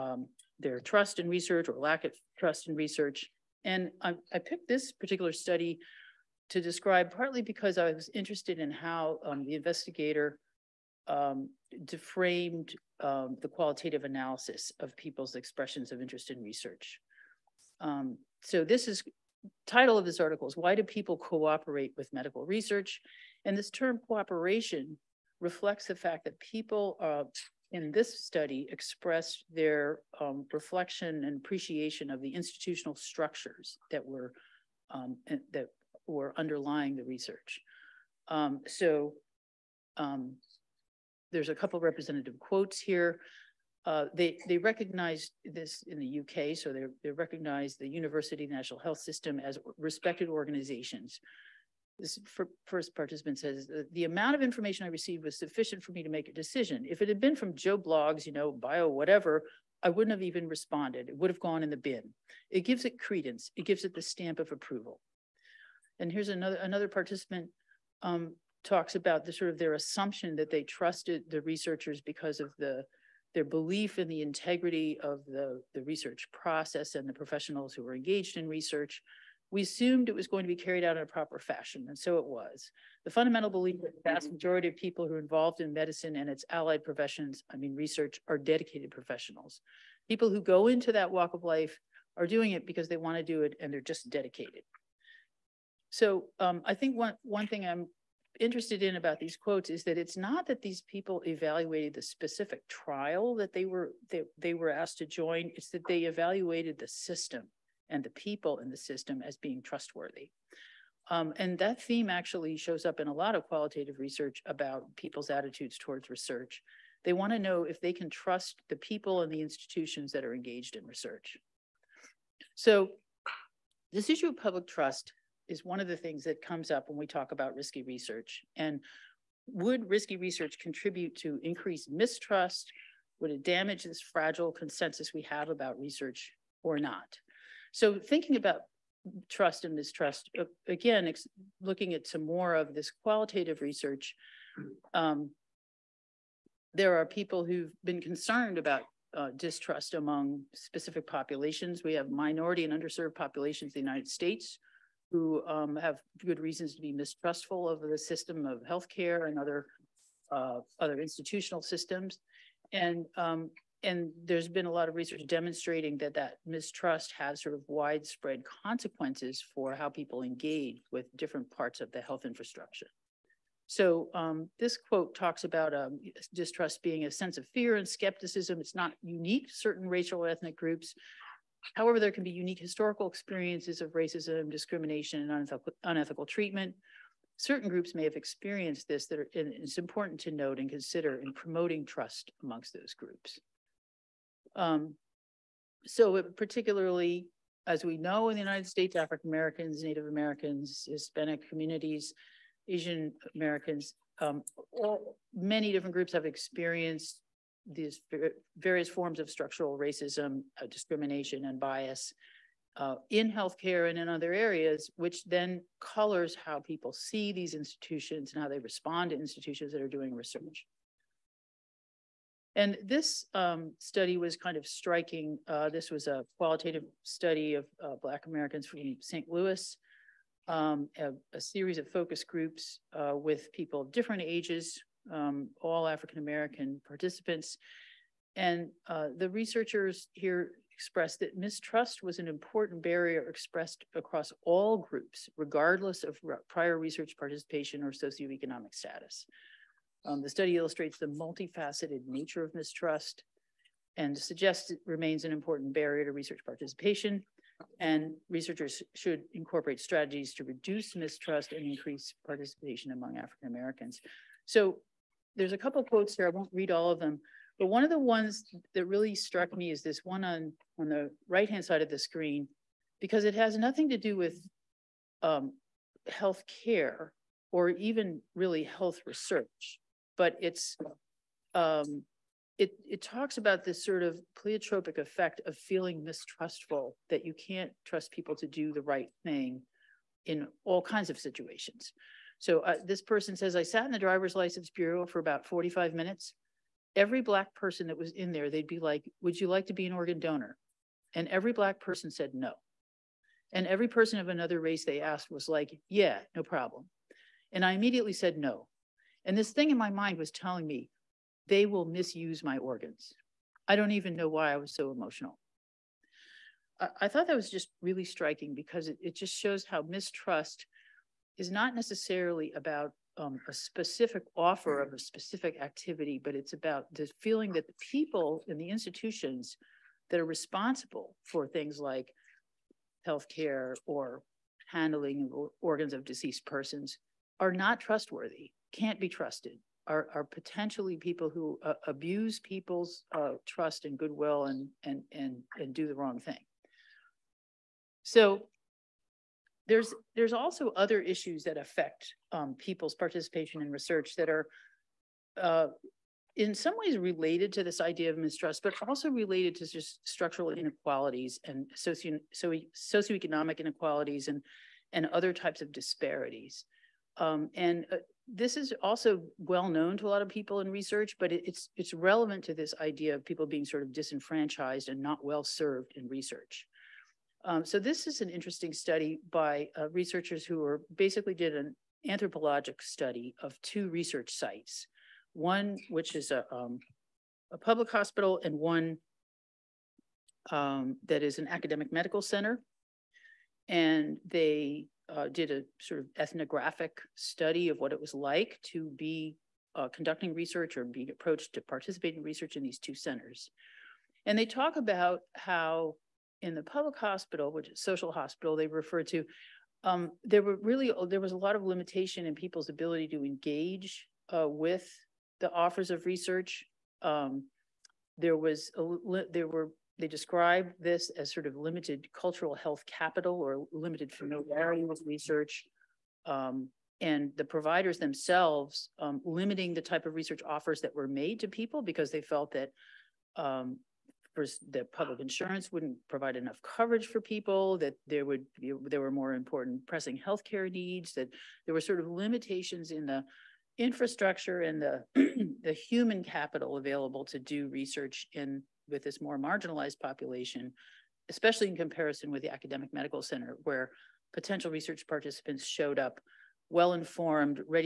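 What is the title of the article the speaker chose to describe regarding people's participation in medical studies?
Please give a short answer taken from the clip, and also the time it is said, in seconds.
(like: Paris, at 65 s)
Why do people cooperate with medical research, at 20 s.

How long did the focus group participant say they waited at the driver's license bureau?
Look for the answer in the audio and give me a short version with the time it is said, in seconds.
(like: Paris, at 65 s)
45 minutes, at 295 s.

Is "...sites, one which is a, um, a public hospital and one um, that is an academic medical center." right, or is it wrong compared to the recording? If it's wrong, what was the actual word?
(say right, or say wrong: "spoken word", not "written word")
right.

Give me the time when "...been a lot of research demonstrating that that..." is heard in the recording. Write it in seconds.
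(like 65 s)
164 s.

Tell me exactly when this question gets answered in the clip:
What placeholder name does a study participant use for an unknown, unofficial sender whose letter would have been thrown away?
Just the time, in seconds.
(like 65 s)
57 s.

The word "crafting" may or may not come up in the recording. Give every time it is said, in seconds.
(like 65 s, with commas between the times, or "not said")
not said.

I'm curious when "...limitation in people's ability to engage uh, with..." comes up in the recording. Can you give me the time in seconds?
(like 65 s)
411 s.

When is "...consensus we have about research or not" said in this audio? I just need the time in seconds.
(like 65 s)
134 s.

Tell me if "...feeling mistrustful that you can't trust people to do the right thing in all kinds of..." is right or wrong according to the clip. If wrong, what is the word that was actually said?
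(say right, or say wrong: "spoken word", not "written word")
right.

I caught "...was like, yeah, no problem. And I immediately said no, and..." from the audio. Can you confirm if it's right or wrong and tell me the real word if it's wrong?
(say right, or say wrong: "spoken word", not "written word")
right.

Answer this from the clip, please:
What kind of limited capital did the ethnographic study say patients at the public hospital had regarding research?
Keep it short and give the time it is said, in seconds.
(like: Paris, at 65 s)
Cultural health capital, at 422 s.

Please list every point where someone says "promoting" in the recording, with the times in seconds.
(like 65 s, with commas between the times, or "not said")
191 s.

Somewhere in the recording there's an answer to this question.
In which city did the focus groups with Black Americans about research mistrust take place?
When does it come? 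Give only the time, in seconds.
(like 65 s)
229 s.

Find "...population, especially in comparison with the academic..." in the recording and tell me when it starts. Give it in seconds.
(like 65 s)
449 s.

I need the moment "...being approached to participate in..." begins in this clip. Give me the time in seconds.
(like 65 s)
400 s.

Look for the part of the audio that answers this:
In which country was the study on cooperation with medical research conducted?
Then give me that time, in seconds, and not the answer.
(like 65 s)
46 s.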